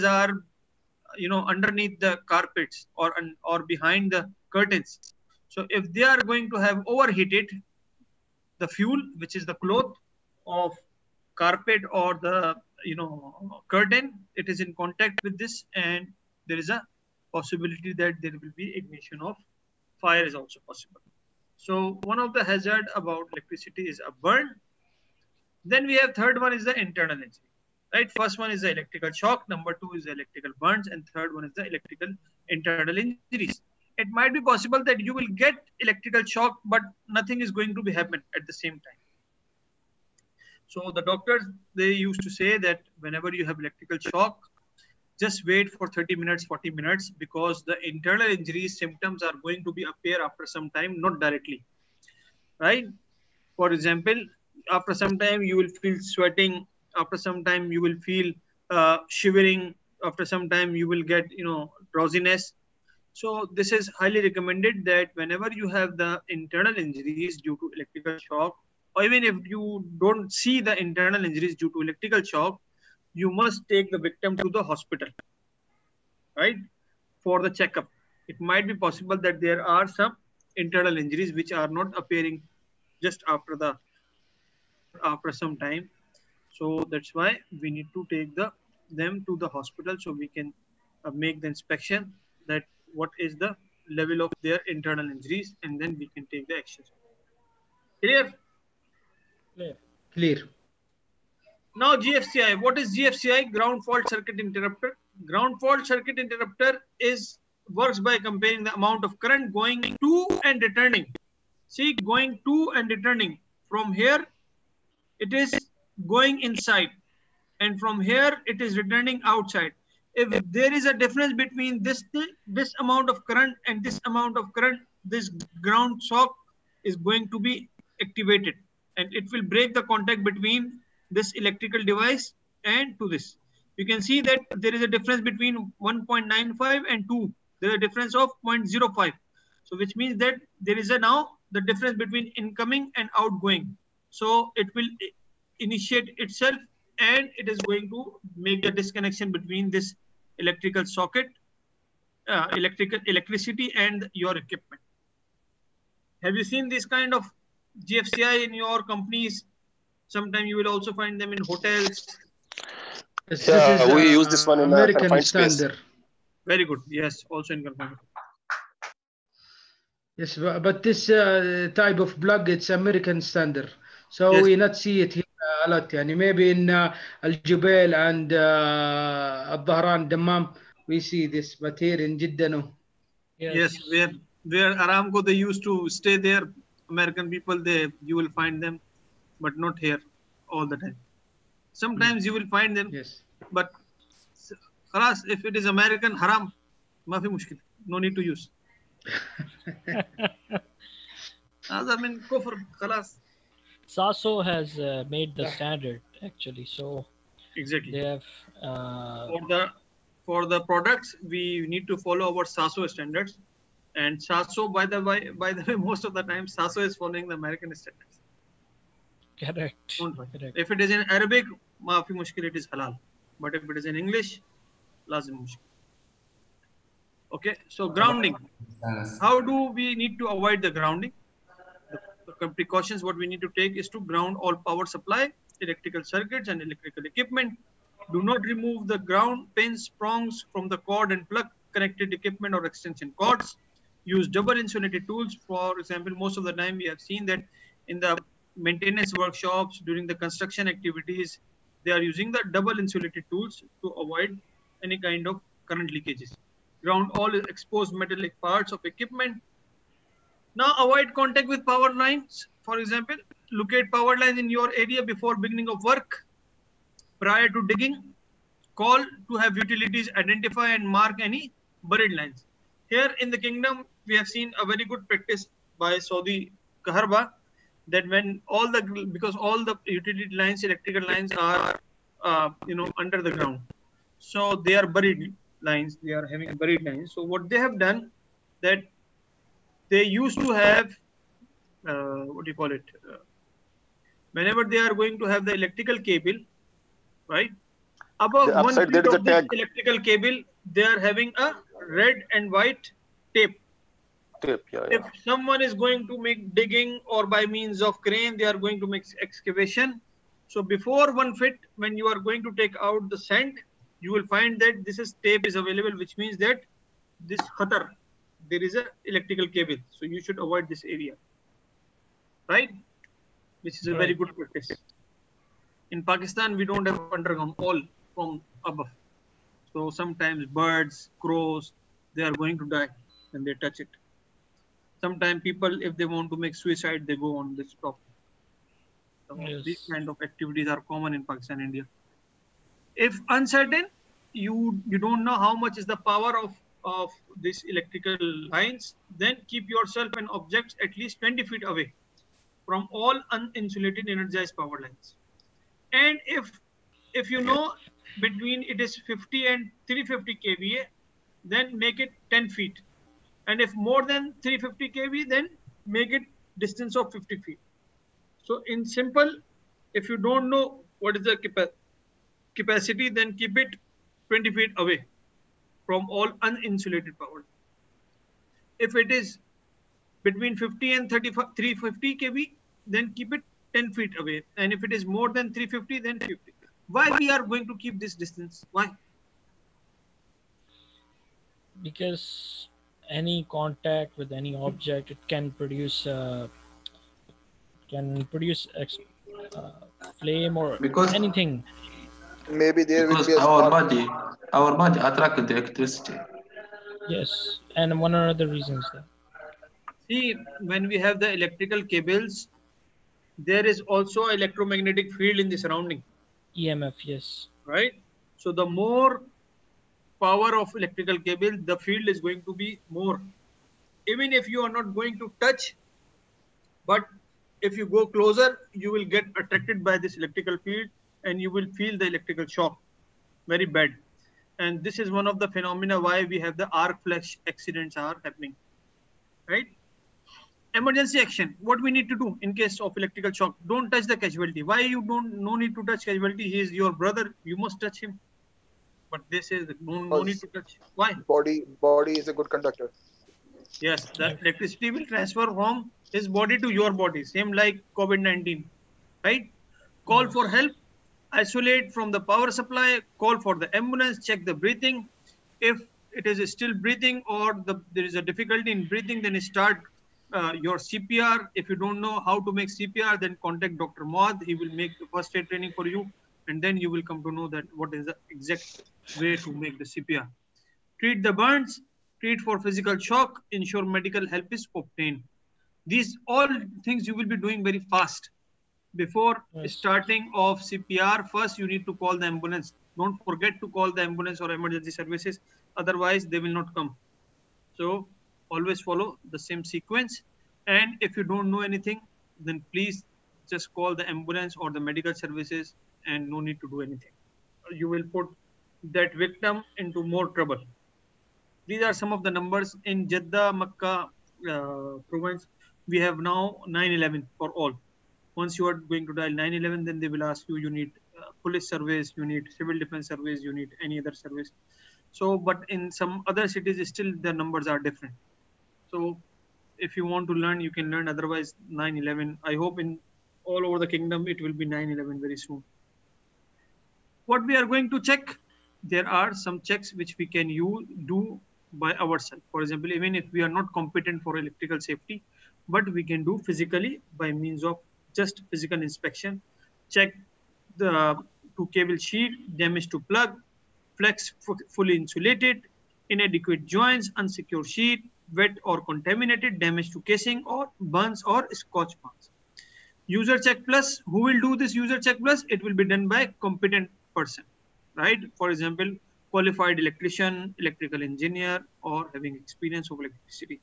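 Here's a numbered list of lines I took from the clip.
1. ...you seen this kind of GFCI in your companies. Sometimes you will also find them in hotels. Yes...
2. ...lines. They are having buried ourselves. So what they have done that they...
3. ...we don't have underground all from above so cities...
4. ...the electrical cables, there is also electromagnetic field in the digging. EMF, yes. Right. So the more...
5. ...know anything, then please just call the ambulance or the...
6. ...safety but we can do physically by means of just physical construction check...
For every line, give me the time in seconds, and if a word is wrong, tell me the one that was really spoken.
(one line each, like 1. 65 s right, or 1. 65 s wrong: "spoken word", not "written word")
1. 156 s right
2. 285 s wrong: "lines", not "ourselves"
3. 326 s wrong: "sometimes", not "cities"
4. 411 s wrong: "surrounding", not "digging"
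5. 501 s right
6. 544 s wrong: "inspection", not "construction".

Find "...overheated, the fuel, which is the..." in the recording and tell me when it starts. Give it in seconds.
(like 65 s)
6 s.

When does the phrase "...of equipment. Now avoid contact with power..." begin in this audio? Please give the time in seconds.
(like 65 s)
258 s.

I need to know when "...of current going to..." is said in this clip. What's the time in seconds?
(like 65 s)
109 s.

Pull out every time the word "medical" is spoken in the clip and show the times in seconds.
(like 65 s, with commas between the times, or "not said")
483 s, 504 s.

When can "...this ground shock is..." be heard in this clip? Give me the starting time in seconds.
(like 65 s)
125 s.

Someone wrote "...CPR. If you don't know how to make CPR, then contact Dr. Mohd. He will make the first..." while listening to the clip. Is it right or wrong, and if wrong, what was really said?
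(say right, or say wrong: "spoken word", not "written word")
right.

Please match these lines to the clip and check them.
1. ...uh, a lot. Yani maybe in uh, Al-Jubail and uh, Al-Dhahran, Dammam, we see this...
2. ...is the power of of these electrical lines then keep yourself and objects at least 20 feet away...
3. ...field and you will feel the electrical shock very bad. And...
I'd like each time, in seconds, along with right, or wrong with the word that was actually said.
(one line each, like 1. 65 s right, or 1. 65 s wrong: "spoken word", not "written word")
1. 175 s right
2. 345 s right
3. 430 s right.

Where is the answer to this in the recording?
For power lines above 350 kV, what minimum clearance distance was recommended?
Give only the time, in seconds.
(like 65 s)
367 s.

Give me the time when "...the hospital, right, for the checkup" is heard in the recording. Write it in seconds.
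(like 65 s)
74 s.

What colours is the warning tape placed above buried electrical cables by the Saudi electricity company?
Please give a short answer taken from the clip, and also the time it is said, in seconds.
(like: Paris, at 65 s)
Red and white, at 301 s.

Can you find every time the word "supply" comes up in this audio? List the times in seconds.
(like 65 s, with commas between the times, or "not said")
234 s, 462 s.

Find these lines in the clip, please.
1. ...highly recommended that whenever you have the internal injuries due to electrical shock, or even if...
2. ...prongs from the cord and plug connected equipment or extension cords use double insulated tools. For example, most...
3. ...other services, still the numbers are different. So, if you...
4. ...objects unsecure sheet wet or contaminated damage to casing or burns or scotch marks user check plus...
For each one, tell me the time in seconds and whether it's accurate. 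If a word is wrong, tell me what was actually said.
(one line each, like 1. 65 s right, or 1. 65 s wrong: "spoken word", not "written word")
1. 63 s right
2. 240 s right
3. 526 s wrong: "cities", not "services"
4. 556 s wrong: "joints", not "objects".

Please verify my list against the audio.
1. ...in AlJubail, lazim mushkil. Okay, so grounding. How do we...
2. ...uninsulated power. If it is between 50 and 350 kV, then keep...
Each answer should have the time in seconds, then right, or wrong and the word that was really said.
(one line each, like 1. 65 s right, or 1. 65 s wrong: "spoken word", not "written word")
1. 223 s wrong: "English", not "AlJubail"
2. 376 s right.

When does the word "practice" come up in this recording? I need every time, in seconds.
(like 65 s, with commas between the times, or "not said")
275 s, 324 s.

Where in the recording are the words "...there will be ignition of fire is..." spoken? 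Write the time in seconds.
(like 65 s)
18 s.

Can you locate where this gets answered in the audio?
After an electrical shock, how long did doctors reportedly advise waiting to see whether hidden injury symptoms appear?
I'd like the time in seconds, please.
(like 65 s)
45 s.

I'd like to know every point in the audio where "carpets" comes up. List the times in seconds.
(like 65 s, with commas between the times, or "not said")
2 s, 11 s.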